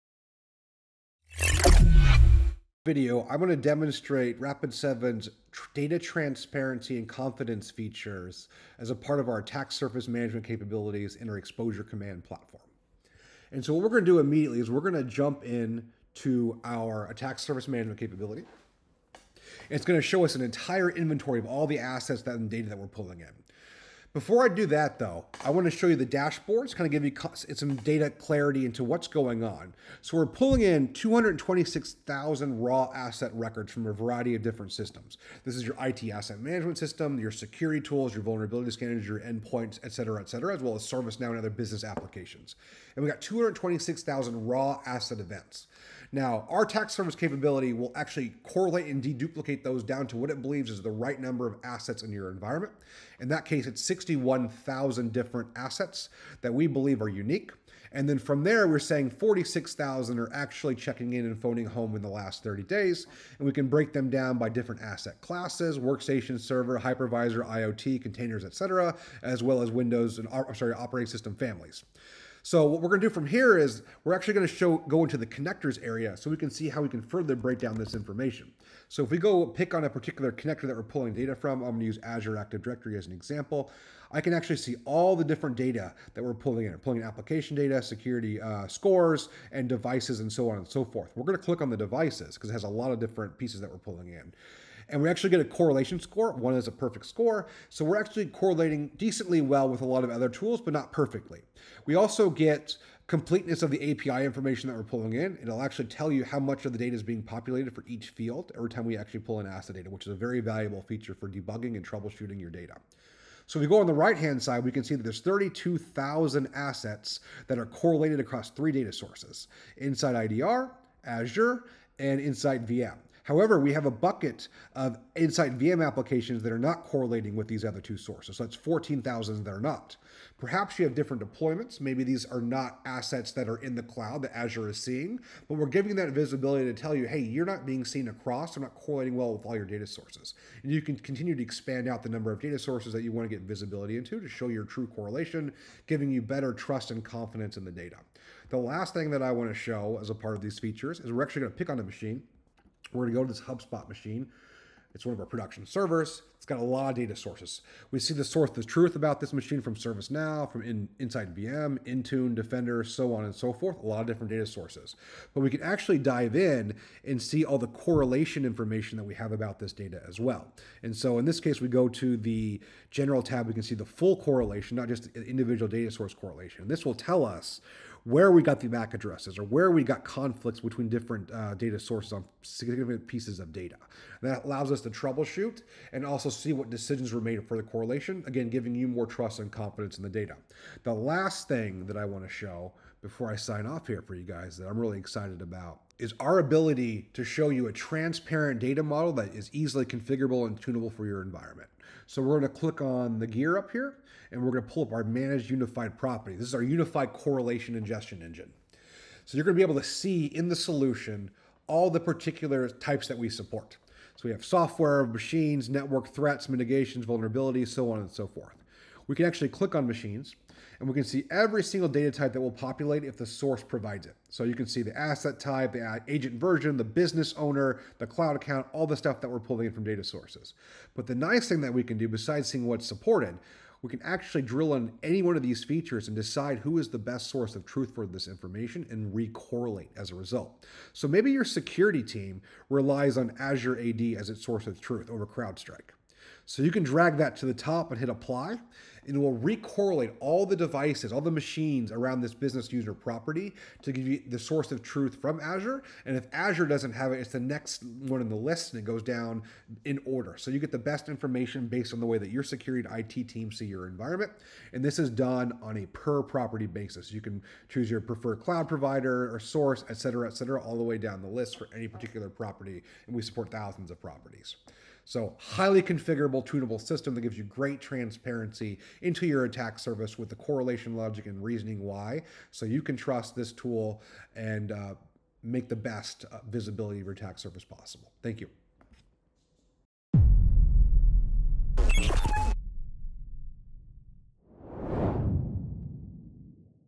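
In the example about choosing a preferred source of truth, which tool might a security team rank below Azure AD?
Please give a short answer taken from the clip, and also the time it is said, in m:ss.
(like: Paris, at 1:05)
CrowdStrike, at 4:05.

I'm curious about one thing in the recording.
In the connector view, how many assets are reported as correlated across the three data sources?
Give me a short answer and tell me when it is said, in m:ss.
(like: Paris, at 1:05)
32,000, at 1:55.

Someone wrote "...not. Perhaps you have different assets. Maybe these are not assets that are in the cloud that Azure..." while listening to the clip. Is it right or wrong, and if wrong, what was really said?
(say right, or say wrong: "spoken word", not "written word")
wrong: "deployments", not "assets".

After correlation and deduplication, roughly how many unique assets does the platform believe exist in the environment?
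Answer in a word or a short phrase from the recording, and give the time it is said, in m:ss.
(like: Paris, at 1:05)
61,000, at 0:53.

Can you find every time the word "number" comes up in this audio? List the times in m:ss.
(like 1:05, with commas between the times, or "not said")
0:51, 2:22.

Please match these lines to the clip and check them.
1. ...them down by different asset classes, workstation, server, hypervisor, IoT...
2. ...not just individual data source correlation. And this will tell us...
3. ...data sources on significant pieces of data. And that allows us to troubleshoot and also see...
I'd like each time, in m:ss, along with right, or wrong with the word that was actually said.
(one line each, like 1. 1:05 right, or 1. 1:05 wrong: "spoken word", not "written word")
1. 1:03 right
2. 2:54 right
3. 3:01 right.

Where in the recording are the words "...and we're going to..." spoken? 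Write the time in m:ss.
3:24.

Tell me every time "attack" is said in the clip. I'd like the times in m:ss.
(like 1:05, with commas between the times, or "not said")
0:09, 0:17, 0:46, 4:39, 4:47.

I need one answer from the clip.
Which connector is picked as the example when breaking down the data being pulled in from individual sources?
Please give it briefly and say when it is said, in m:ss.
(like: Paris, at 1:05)
Azure Active Directory, at 1:22.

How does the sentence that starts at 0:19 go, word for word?
It's going to show us an entire inventory of all the assets and data that we're pulling in.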